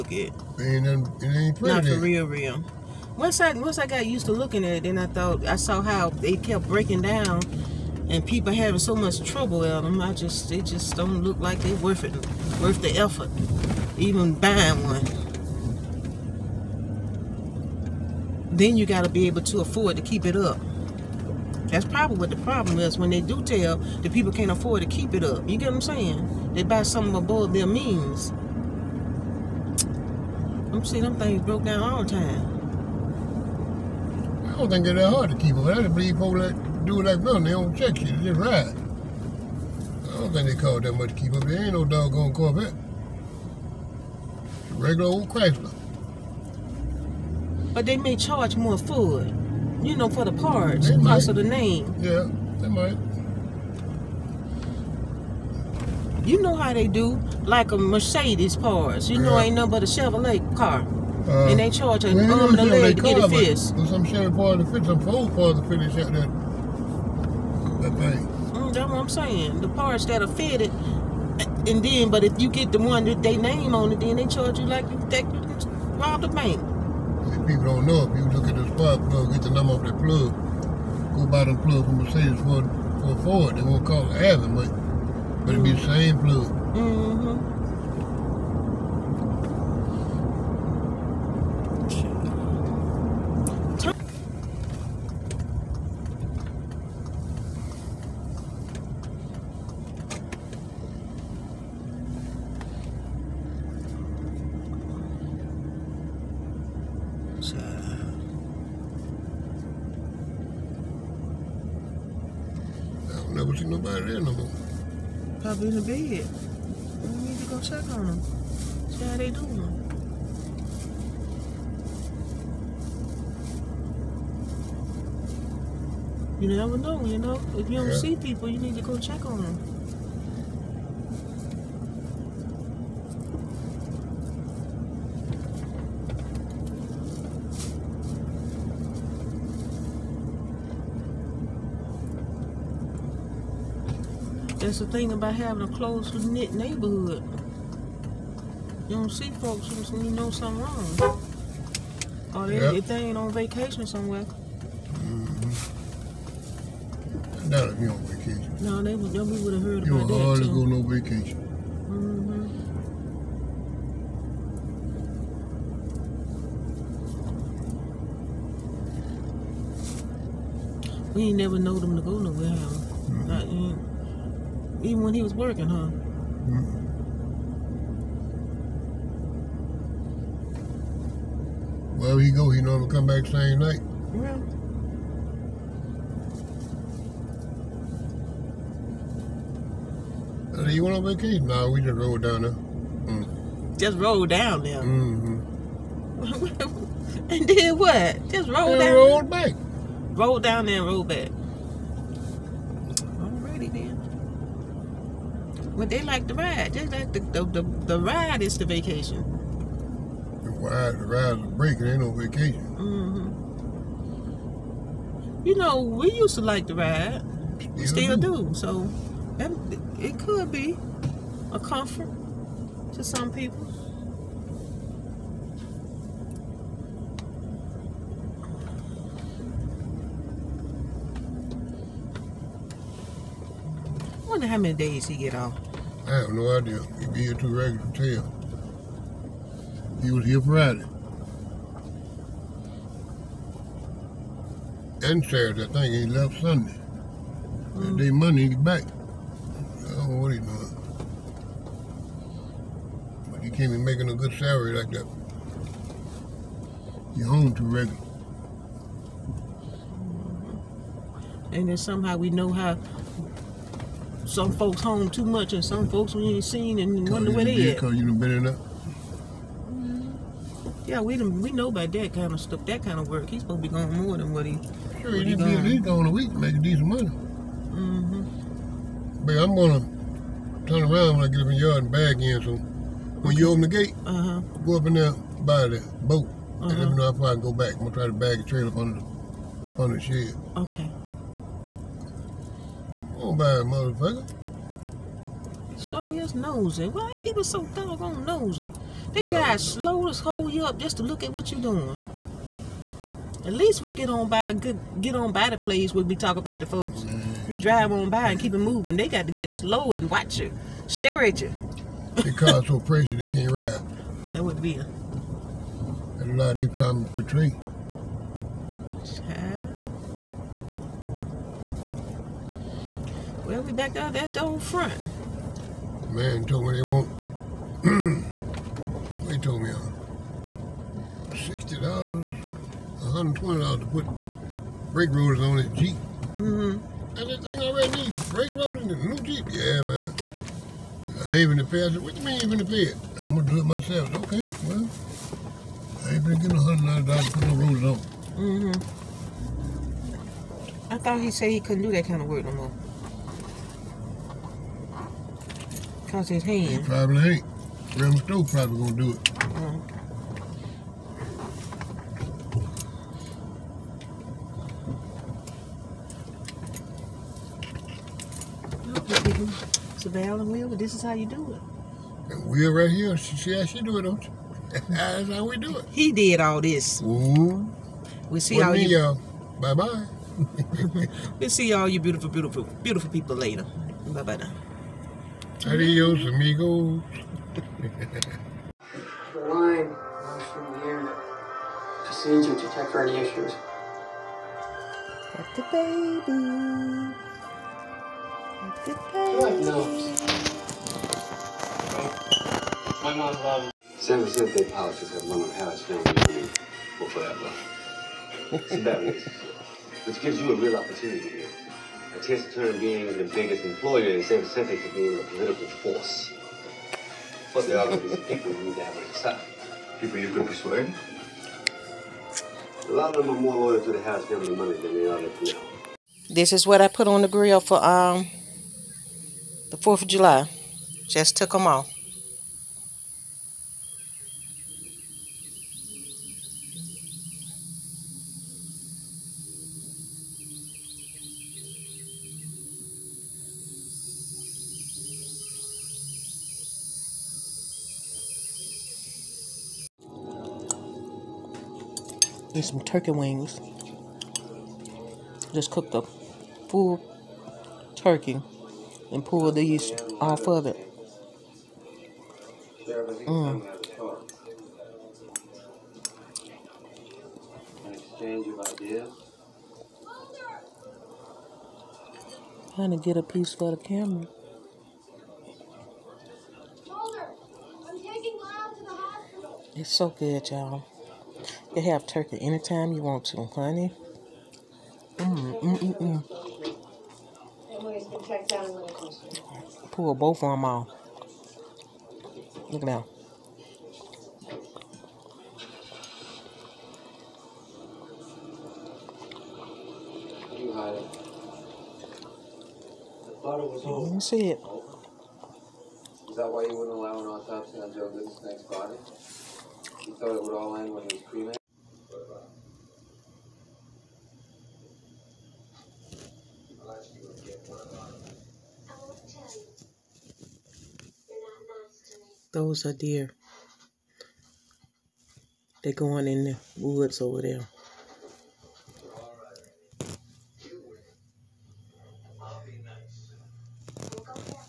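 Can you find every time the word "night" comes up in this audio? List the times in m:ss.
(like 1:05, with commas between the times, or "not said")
3:03.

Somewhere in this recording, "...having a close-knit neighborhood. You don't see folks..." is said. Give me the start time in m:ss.
2:25.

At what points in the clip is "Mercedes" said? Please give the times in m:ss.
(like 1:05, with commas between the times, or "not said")
0:57, 1:22.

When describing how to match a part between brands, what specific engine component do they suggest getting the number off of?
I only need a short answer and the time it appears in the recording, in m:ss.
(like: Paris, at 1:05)
spark plug, at 1:18.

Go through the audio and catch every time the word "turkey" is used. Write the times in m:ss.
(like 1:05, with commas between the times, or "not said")
7:32, 7:37, 8:02.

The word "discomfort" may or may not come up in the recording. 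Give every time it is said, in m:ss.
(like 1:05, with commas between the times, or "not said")
not said.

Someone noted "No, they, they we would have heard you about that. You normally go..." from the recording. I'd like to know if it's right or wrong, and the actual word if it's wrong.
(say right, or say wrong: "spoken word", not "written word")
wrong: "hardly", not "normally".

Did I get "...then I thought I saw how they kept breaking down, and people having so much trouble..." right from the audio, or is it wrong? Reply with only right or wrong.
right.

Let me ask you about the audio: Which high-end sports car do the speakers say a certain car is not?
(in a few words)
Corvette.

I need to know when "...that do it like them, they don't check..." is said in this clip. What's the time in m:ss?
0:36.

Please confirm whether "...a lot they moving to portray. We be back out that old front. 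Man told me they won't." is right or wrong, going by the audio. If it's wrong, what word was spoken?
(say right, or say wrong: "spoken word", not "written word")
wrong: "trying", not "moving".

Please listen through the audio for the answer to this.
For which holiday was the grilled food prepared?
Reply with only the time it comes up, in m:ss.
7:09.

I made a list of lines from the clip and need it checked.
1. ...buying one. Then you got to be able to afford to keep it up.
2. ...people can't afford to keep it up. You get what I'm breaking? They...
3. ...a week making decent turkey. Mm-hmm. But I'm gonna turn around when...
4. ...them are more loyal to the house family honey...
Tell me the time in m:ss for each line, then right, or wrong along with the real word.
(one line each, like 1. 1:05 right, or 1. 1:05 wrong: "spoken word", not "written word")
1. 0:14 right
2. 0:24 wrong: "saying", not "breaking"
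3. 4:36 wrong: "money", not "turkey"
4. 7:03 wrong: "money", not "honey".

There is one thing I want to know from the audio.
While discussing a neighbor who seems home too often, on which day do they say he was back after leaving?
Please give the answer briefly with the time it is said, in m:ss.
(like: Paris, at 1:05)
Monday, at 4:08.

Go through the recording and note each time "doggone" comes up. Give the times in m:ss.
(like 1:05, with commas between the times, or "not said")
0:41, 4:57.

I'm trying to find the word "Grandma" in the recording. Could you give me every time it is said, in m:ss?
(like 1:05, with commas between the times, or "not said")
5:57.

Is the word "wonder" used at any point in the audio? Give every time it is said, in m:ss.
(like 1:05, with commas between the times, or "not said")
3:54, 4:27.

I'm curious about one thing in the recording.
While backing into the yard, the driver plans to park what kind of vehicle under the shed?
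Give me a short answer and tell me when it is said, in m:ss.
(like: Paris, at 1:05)
trailer, at 4:48.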